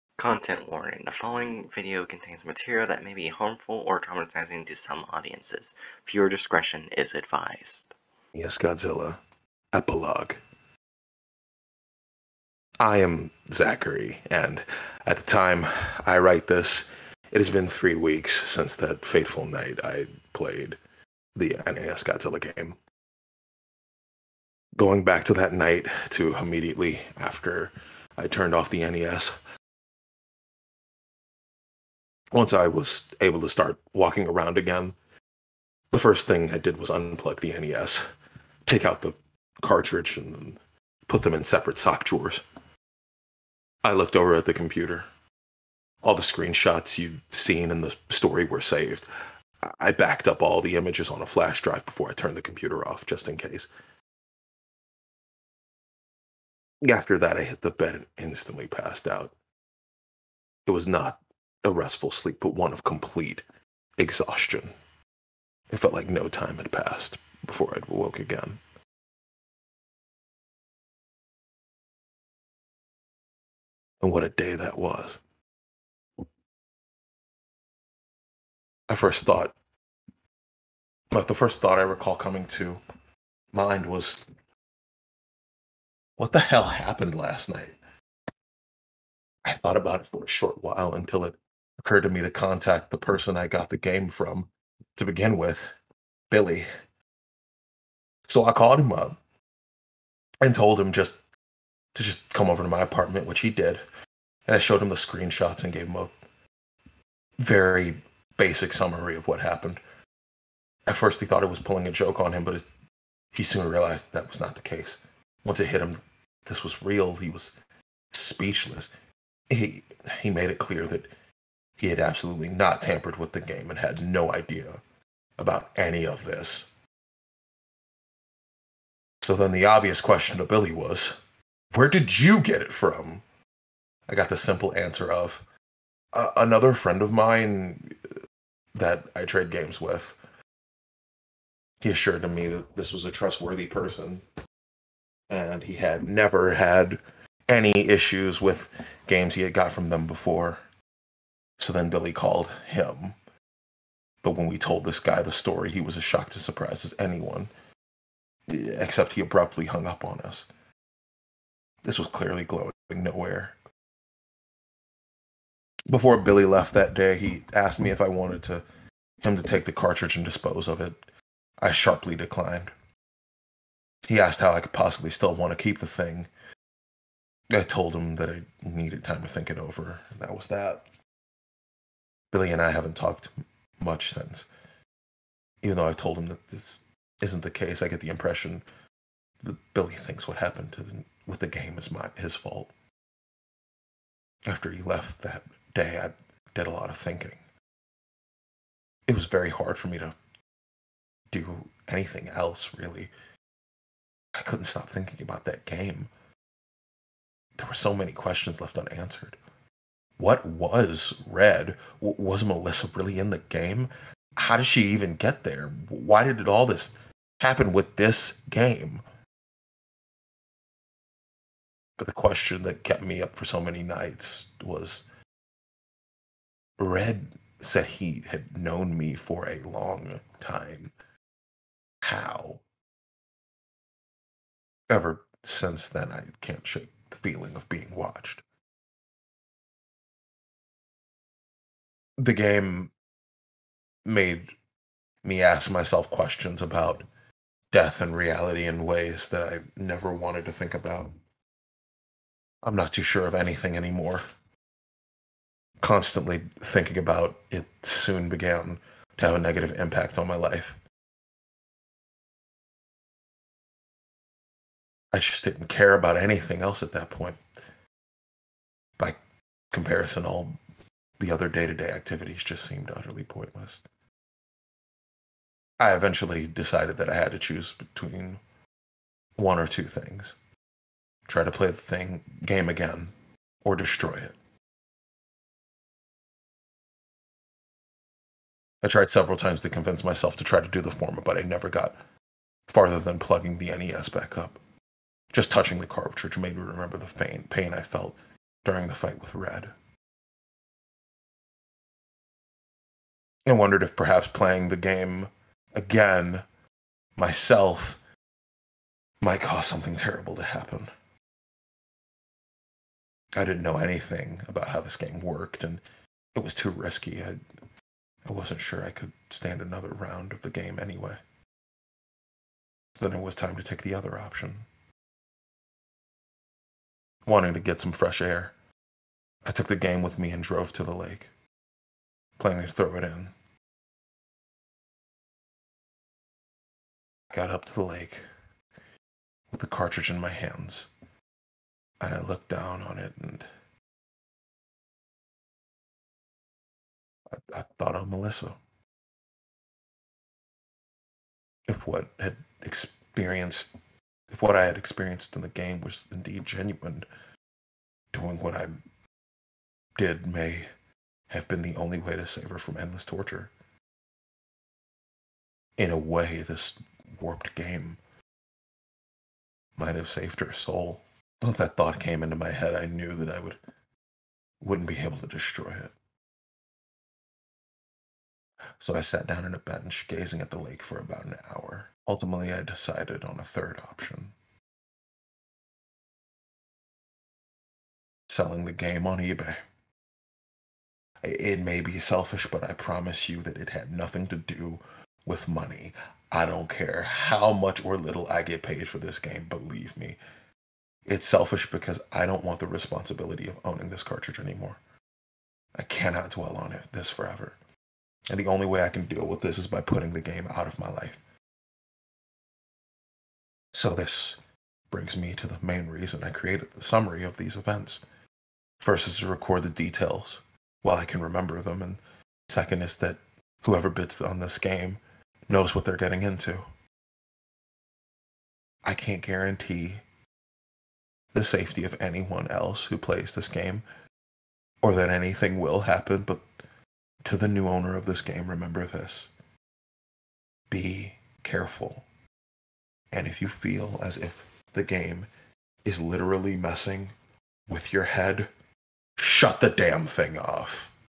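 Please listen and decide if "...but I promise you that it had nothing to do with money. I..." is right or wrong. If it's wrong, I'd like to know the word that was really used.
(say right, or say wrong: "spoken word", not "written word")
right.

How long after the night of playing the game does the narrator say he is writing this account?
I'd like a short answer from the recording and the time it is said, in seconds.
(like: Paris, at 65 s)
3 weeks, at 17 s.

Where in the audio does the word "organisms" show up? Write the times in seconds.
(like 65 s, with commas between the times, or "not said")
not said.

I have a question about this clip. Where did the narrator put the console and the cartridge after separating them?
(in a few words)
Separate sock drawers.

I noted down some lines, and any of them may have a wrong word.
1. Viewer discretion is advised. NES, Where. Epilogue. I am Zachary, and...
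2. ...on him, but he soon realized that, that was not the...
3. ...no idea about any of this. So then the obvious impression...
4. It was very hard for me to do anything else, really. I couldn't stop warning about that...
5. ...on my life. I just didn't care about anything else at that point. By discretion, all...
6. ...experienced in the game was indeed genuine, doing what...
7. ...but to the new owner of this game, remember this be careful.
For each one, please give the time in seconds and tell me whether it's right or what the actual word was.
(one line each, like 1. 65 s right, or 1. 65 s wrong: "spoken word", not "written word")
1. 6 s wrong: "Godzilla", not "Where"
2. 112 s right
3. 124 s wrong: "question", not "impression"
4. 199 s wrong: "thinking", not "warning"
5. 260 s wrong: "comparison", not "discretion"
6. 354 s right
7. 436 s right.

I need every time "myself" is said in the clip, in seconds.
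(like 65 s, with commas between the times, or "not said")
245 s, 290 s, 307 s.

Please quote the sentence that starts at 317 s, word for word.
I, I wasn't sure I could stand another round of the game anyway.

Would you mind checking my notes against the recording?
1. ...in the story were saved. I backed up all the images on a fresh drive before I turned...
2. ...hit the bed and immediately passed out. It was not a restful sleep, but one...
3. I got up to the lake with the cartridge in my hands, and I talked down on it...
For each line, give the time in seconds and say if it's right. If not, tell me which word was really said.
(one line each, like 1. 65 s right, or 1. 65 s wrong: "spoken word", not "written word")
1. 47 s wrong: "flash", not "fresh"
2. 57 s wrong: "instantly", not "immediately"
3. 337 s wrong: "looked", not "talked".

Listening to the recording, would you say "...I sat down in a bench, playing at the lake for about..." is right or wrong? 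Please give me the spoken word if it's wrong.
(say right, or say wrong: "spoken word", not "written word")
wrong: "gazing", not "playing".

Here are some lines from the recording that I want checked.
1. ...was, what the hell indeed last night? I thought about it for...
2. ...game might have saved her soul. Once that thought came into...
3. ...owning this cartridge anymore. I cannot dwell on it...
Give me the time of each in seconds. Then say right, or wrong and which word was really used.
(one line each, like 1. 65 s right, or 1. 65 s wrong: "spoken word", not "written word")
1. 83 s wrong: "happened", not "indeed"
2. 367 s right
3. 403 s right.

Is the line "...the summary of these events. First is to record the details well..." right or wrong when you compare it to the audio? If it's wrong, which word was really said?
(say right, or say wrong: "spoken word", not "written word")
right.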